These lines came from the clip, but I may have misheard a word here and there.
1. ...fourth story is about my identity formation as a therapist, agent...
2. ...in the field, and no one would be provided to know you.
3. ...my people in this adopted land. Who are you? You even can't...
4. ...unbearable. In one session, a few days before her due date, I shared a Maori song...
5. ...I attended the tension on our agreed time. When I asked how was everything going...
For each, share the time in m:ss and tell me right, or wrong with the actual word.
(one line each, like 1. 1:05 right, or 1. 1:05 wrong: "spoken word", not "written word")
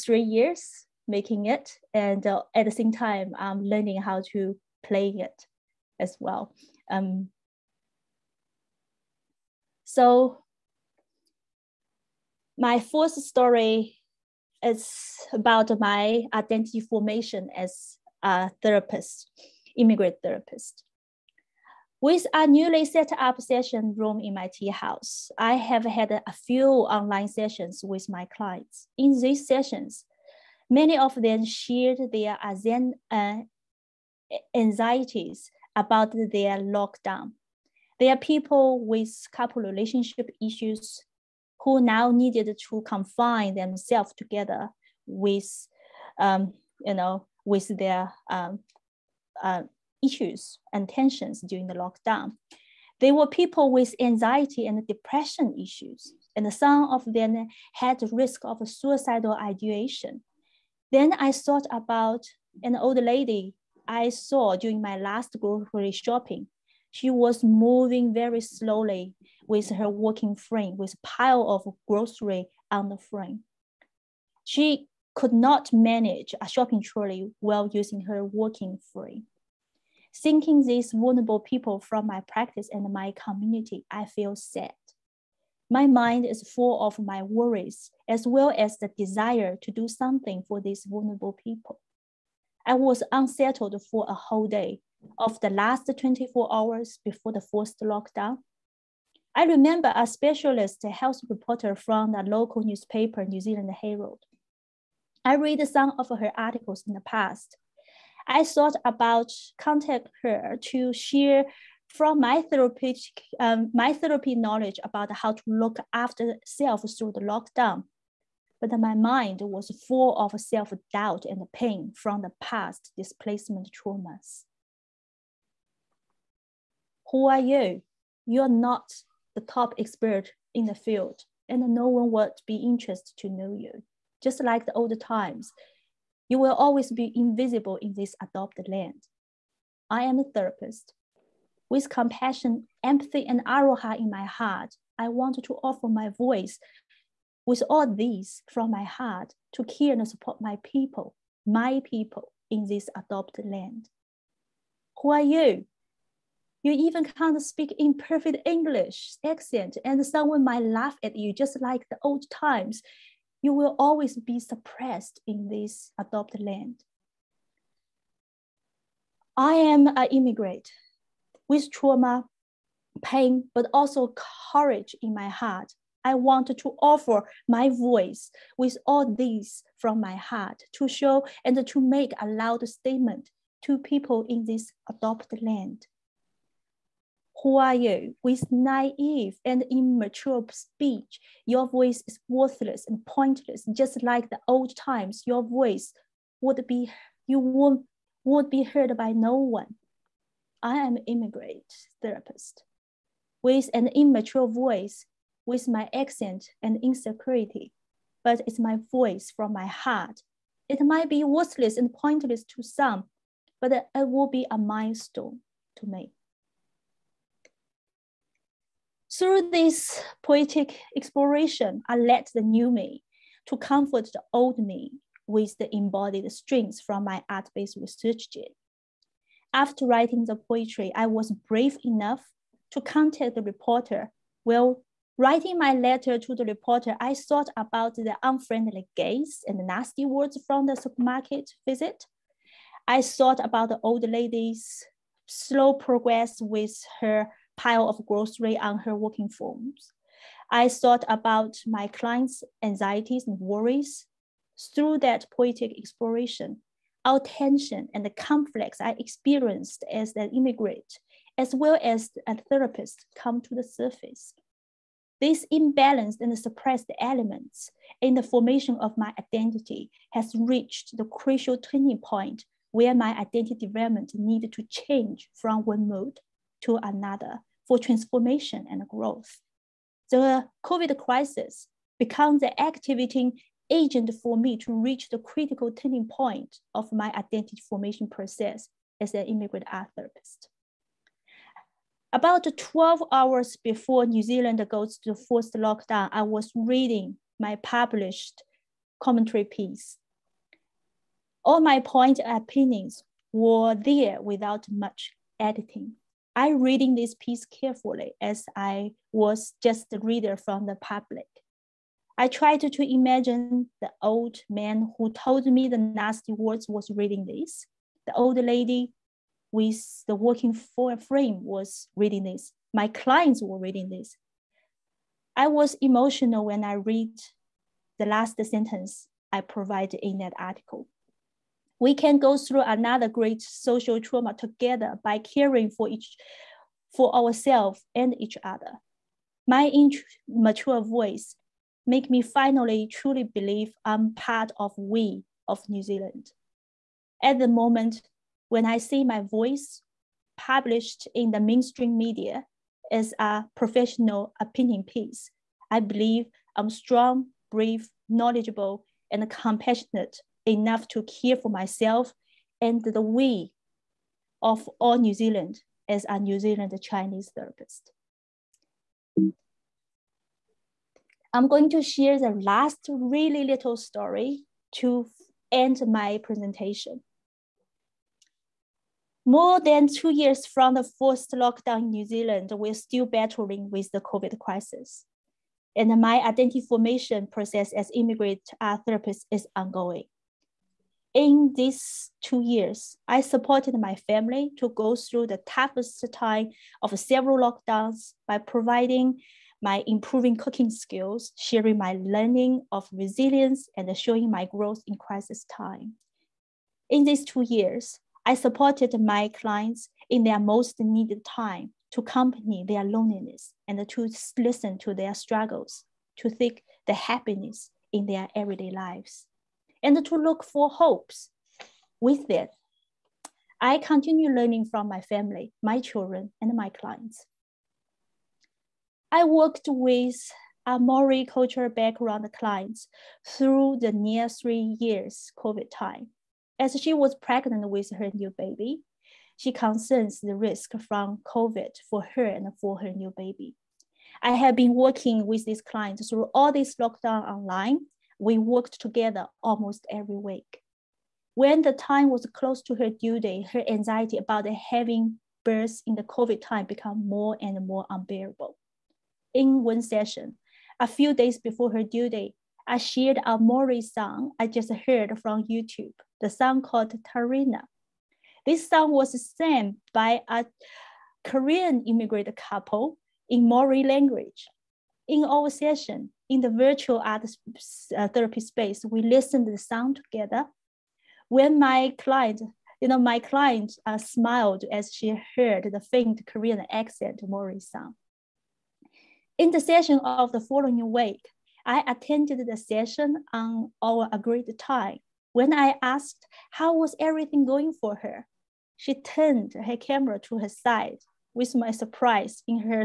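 1. 0:12 wrong: "immigrant", not "agent"
2. 2:10 wrong: "interested", not "provided"
3. 2:31 right
4. 7:37 right
5. 8:11 wrong: "session", not "tension".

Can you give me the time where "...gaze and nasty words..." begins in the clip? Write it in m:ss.
3:58.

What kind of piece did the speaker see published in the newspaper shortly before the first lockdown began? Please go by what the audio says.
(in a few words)
commentary piece.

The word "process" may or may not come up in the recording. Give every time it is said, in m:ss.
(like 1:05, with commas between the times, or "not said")
4:48, 6:27.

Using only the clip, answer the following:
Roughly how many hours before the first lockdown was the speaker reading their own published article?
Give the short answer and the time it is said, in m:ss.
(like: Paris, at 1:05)
12, at 4:52.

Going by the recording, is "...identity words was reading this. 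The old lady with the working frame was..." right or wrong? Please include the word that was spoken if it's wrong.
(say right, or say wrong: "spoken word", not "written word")
wrong: "nasty", not "identity".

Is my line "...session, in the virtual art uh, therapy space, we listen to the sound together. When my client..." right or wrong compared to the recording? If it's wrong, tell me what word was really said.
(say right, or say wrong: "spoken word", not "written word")
right.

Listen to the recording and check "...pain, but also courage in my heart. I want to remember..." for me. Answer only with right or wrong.
wrong.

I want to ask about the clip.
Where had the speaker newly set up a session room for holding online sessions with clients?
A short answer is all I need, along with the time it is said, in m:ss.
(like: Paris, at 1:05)
tea house, at 0:24.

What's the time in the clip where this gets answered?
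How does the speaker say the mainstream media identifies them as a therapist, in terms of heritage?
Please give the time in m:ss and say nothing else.
6:06.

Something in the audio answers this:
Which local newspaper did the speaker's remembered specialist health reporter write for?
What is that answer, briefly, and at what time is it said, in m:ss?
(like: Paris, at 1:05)
New Zealand Herald, at 1:43.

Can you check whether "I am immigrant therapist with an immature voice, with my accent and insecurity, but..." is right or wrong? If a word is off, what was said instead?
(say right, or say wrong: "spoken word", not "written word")
right.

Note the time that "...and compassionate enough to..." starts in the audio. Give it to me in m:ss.
5:59.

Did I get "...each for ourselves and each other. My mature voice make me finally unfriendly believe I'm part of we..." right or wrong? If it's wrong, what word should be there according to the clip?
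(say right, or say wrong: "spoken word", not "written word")
wrong: "truly", not "unfriendly".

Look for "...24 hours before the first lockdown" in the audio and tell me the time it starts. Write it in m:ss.
1:36.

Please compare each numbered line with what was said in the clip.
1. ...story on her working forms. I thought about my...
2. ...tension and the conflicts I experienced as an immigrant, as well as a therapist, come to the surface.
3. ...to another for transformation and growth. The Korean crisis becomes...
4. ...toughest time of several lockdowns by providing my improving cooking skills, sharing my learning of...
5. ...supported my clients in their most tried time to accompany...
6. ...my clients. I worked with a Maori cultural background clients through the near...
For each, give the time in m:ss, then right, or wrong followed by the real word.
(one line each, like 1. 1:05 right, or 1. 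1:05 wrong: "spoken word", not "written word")
1. 4:08 wrong: "grocery", not "story"
2. 4:17 right
3. 4:36 wrong: "COVID", not "Korean"
4. 6:35 right
5. 6:48 wrong: "needed", not "tried"
6. 7:06 right.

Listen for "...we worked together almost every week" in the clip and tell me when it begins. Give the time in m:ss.
7:28.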